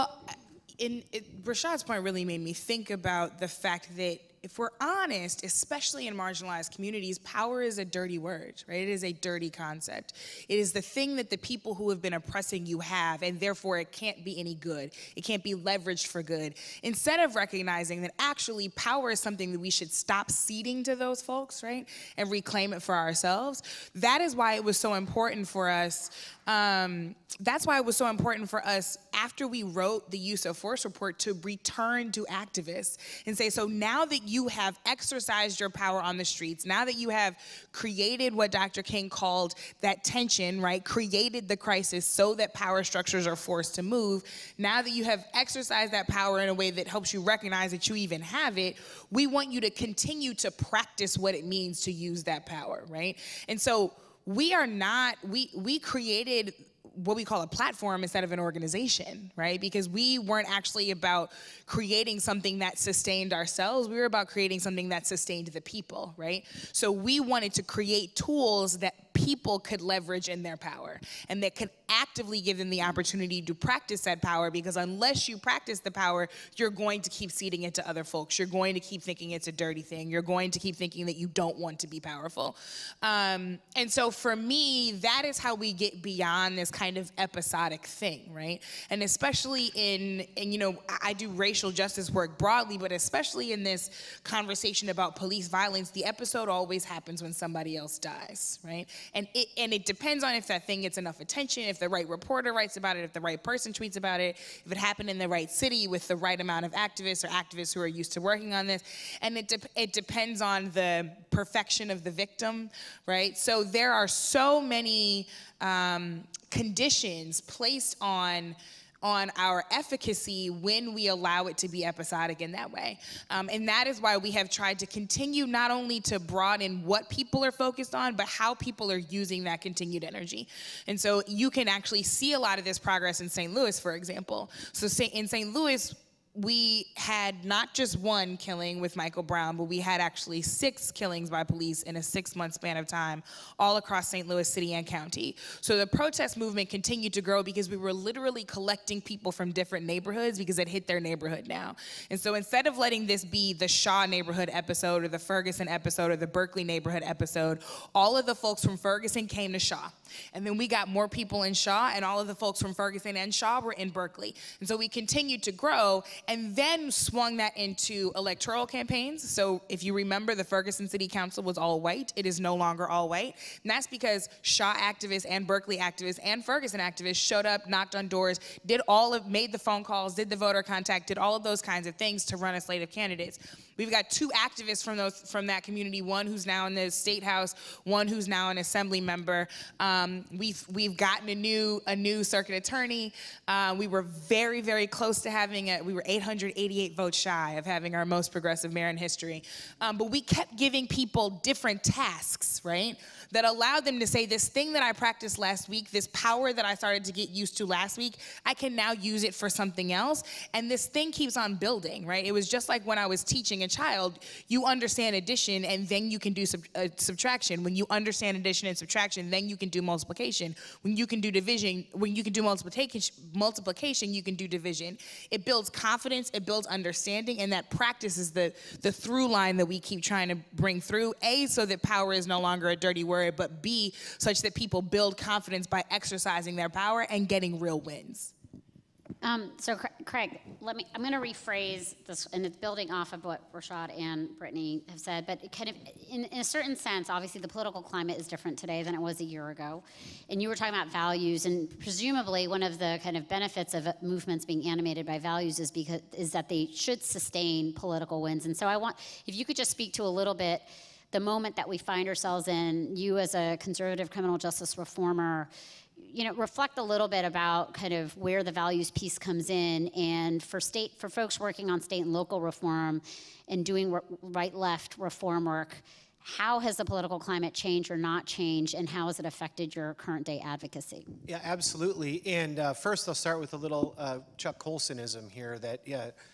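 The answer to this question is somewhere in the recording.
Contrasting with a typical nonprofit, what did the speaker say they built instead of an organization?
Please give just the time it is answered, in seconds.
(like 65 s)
57 s.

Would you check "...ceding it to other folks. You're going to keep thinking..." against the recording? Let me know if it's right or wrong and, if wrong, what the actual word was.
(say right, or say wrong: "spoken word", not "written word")
right.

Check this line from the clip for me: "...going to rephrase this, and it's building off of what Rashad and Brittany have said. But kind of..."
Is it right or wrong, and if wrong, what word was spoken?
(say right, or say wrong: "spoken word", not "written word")
right.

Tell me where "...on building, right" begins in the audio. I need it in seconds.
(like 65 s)
211 s.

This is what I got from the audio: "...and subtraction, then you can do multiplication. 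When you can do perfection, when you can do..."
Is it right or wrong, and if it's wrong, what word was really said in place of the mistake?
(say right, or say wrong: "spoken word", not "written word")
wrong: "division", not "perfection".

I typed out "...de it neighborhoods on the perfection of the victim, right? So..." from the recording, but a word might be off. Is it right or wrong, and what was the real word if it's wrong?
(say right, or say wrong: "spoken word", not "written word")
wrong: "depends", not "neighborhoods".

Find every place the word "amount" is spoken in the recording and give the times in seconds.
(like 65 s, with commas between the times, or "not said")
106 s.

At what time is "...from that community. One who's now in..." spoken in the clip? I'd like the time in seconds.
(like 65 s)
185 s.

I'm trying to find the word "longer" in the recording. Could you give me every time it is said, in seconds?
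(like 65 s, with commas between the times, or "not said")
172 s, 232 s.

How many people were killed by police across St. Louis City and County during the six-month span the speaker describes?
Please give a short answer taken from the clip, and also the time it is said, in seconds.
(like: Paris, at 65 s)
6, at 140 s.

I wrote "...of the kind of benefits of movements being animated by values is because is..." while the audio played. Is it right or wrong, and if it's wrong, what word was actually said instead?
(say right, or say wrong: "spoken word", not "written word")
right.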